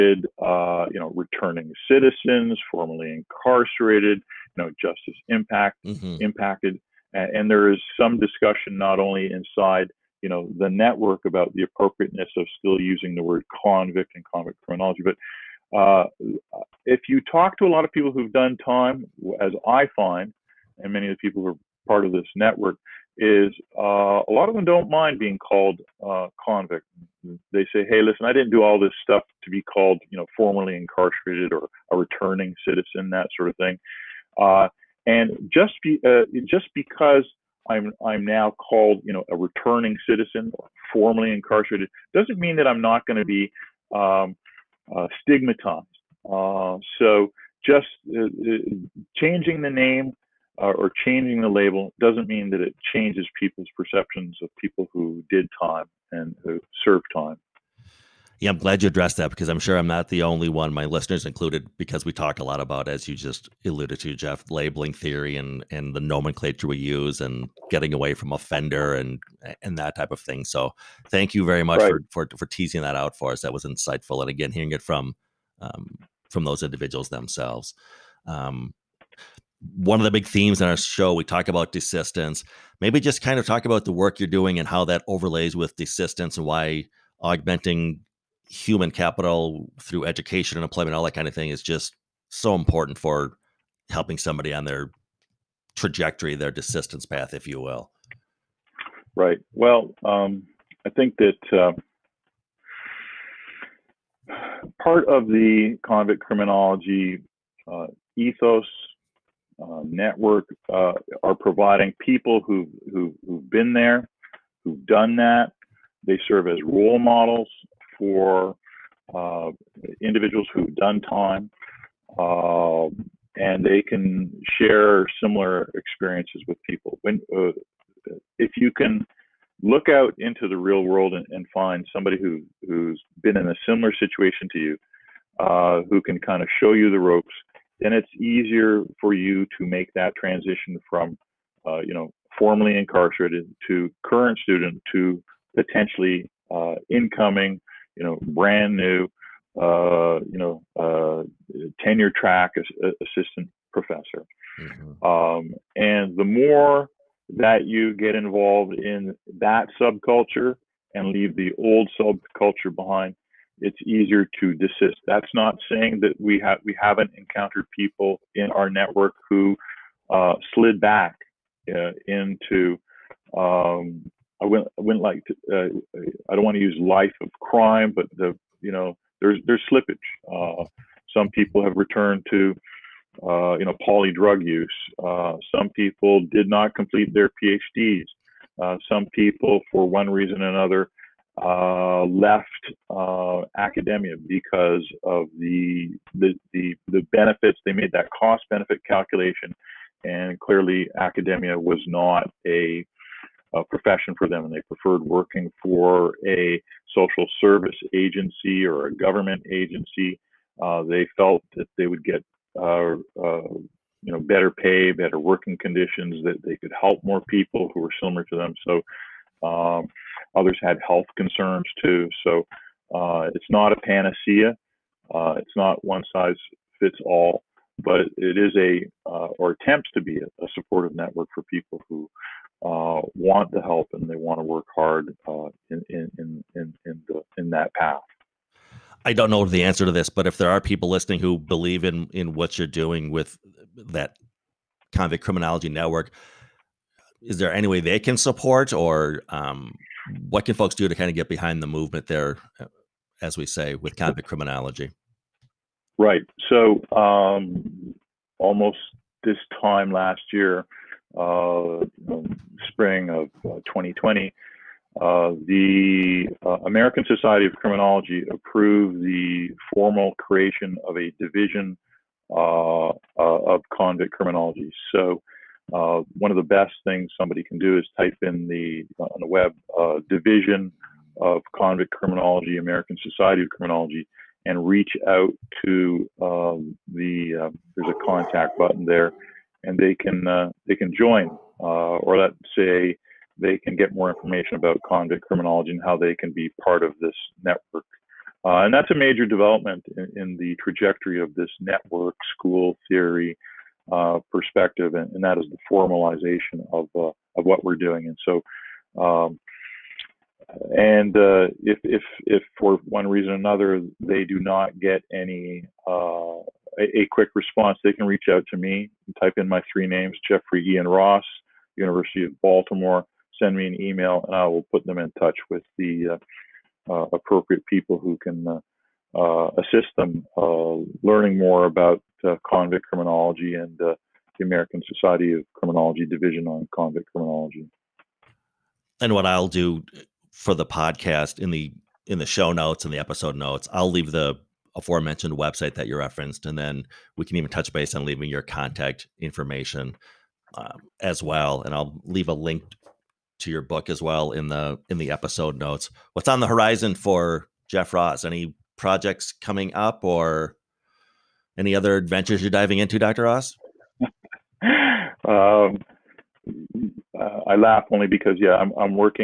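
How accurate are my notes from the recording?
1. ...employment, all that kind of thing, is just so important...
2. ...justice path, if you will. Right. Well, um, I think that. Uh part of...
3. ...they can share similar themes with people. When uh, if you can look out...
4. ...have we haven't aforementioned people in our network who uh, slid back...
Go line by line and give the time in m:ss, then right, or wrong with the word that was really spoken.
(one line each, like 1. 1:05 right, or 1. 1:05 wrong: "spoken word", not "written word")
1. 1:30 right
2. 1:36 wrong: "desistance", not "justice"
3. 2:03 wrong: "experiences", not "themes"
4. 2:46 wrong: "encountered", not "aforementioned".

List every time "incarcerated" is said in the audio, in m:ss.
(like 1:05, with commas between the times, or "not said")
0:03, 0:30, 0:41, 2:22.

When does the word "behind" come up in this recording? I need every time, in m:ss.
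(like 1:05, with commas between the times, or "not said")
2:42, 4:11.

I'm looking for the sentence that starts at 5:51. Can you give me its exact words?
And I'll leave a link to your book as well in the in the episode notes.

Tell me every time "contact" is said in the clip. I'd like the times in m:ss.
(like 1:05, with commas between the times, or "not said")
4:48, 5:48.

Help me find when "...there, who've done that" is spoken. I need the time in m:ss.
1:53.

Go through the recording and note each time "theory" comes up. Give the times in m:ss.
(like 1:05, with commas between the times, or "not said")
1:04, 5:02.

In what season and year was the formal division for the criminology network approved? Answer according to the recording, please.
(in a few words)
Spring of 2020.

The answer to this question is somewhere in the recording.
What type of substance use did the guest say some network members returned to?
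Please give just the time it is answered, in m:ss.
3:03.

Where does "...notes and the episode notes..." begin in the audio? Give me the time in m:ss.
5:42.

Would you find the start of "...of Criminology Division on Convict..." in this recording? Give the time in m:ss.
5:35.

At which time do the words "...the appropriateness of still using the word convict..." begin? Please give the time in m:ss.
0:11.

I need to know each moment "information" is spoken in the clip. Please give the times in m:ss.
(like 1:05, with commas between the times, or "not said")
4:54, 5:49.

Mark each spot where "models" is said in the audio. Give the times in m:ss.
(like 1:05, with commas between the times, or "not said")
1:56.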